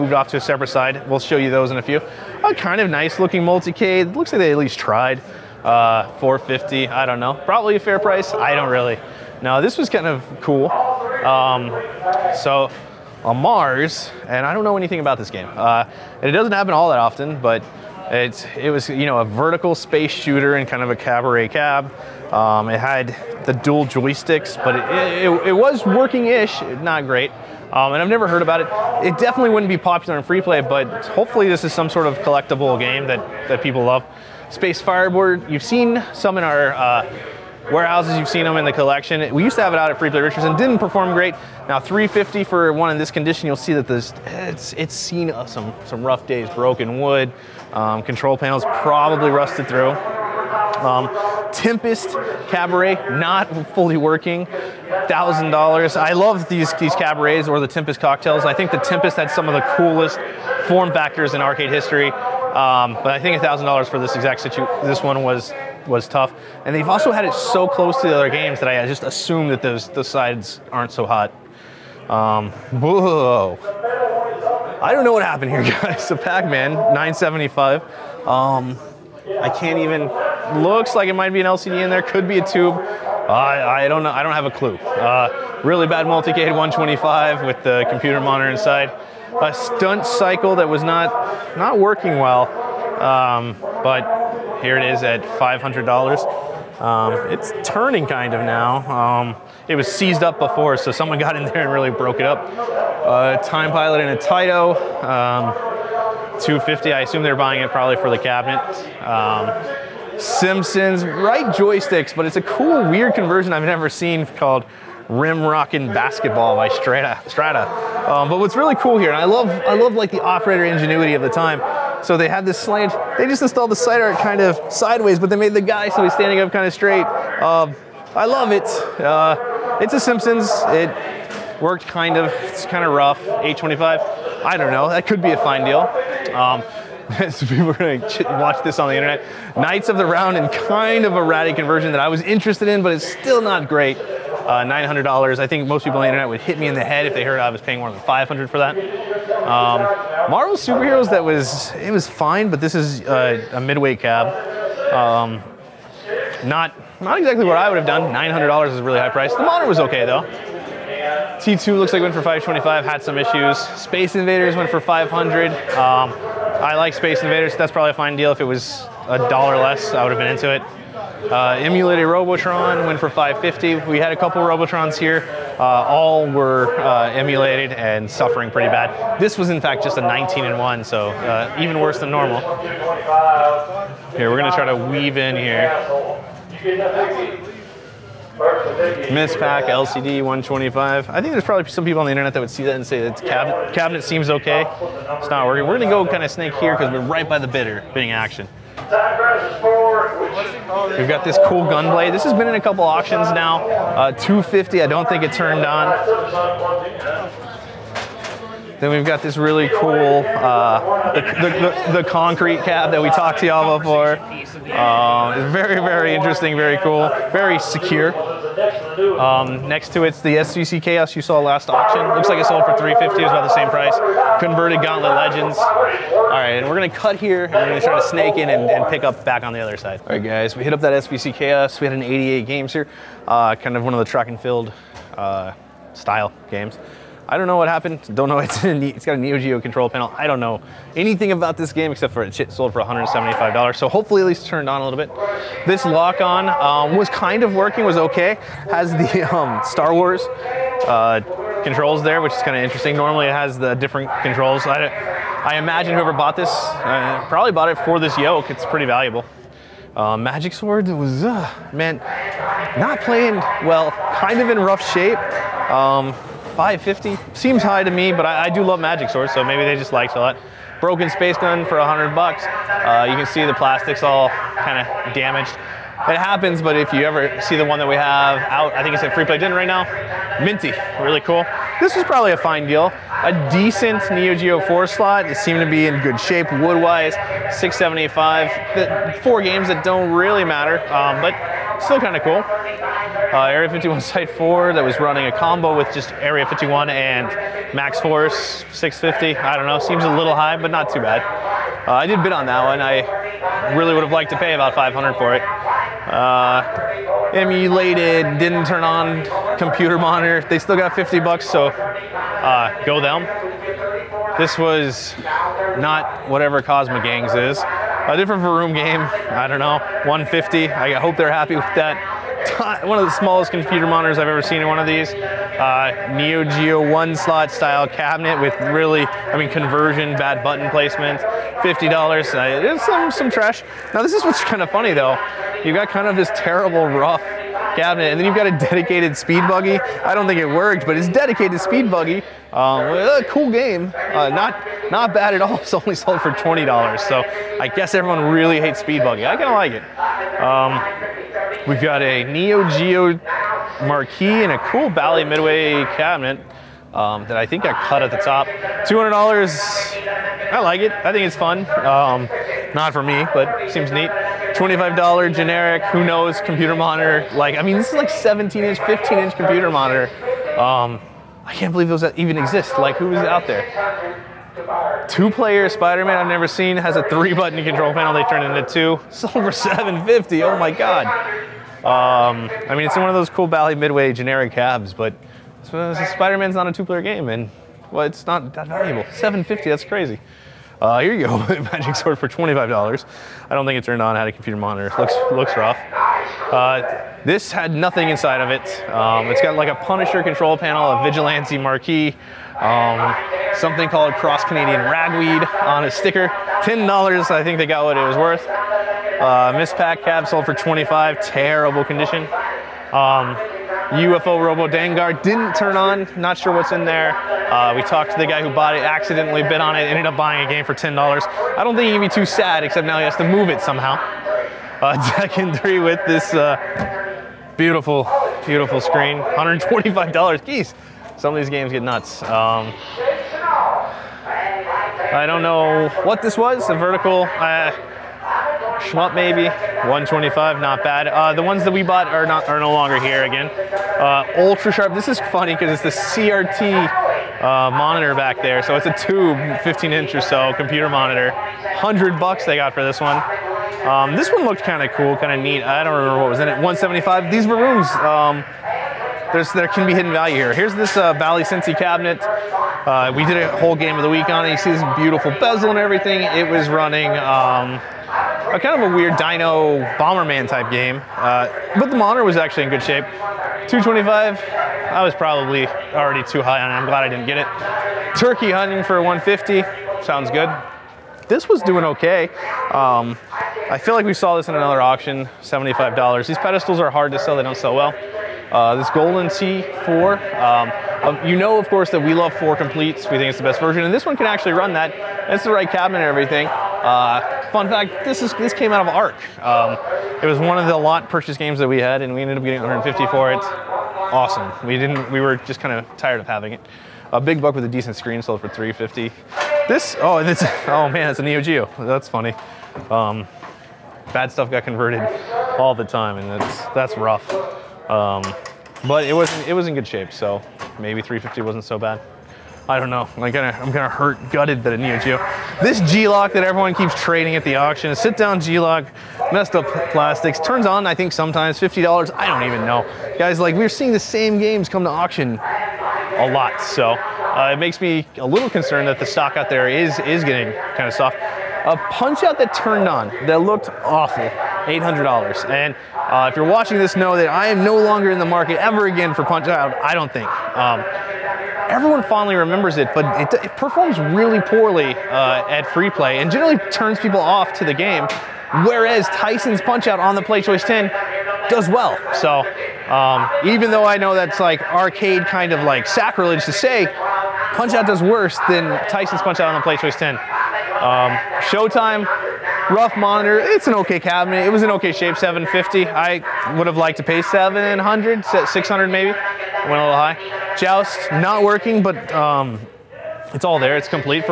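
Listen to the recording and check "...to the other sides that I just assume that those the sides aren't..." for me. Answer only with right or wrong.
wrong.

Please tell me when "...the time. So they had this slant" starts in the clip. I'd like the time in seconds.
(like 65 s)
121 s.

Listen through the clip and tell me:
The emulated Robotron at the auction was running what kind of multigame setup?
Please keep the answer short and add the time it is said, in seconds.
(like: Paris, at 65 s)
19 in 1, at 180 s.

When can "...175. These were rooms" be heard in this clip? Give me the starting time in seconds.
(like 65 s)
456 s.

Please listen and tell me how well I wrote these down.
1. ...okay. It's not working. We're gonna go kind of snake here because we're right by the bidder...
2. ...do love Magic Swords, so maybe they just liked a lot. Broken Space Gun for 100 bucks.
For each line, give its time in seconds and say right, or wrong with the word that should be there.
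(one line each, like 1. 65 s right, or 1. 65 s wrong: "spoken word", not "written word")
1. 194 s right
2. 268 s right.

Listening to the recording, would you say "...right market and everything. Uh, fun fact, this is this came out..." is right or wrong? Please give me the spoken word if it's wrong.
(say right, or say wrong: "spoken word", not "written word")
wrong: "cabinet", not "market".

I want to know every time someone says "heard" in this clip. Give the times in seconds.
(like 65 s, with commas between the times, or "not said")
28 s, 147 s.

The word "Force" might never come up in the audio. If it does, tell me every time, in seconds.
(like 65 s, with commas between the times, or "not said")
297 s.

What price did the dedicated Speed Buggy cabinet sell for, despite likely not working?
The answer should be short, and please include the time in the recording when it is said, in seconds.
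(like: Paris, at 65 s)
$20, at 346 s.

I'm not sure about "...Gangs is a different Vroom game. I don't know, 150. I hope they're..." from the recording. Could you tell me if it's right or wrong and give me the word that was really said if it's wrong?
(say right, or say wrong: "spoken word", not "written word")
right.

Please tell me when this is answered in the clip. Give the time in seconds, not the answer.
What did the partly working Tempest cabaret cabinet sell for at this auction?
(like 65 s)
55 s.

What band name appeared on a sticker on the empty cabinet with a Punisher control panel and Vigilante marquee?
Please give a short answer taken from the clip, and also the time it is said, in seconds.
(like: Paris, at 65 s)
Cross Canadian Ragweed, at 404 s.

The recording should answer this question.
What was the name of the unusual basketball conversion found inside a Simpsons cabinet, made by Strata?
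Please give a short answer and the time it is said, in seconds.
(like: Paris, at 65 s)
Rim Rockin' Basketball, at 115 s.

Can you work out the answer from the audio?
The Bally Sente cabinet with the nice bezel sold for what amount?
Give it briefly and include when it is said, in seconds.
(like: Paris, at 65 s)
$225, at 473 s.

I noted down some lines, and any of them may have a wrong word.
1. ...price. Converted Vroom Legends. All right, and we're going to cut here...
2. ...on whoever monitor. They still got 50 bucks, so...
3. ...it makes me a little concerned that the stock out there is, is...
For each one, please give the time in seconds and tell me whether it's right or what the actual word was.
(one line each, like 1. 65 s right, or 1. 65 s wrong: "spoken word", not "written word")
1. 223 s wrong: "Gauntlet", not "Vroom"
2. 308 s wrong: "computer", not "whoever"
3. 537 s right.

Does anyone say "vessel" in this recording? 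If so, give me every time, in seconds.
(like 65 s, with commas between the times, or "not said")
not said.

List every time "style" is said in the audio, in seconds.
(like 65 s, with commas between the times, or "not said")
235 s, 327 s.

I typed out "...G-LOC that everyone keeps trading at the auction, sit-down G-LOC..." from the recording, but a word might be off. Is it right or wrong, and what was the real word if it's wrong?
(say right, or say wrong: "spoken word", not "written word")
right.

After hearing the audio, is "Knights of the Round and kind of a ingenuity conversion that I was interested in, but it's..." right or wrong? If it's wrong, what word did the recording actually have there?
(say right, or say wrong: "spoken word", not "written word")
wrong: "ratty", not "ingenuity".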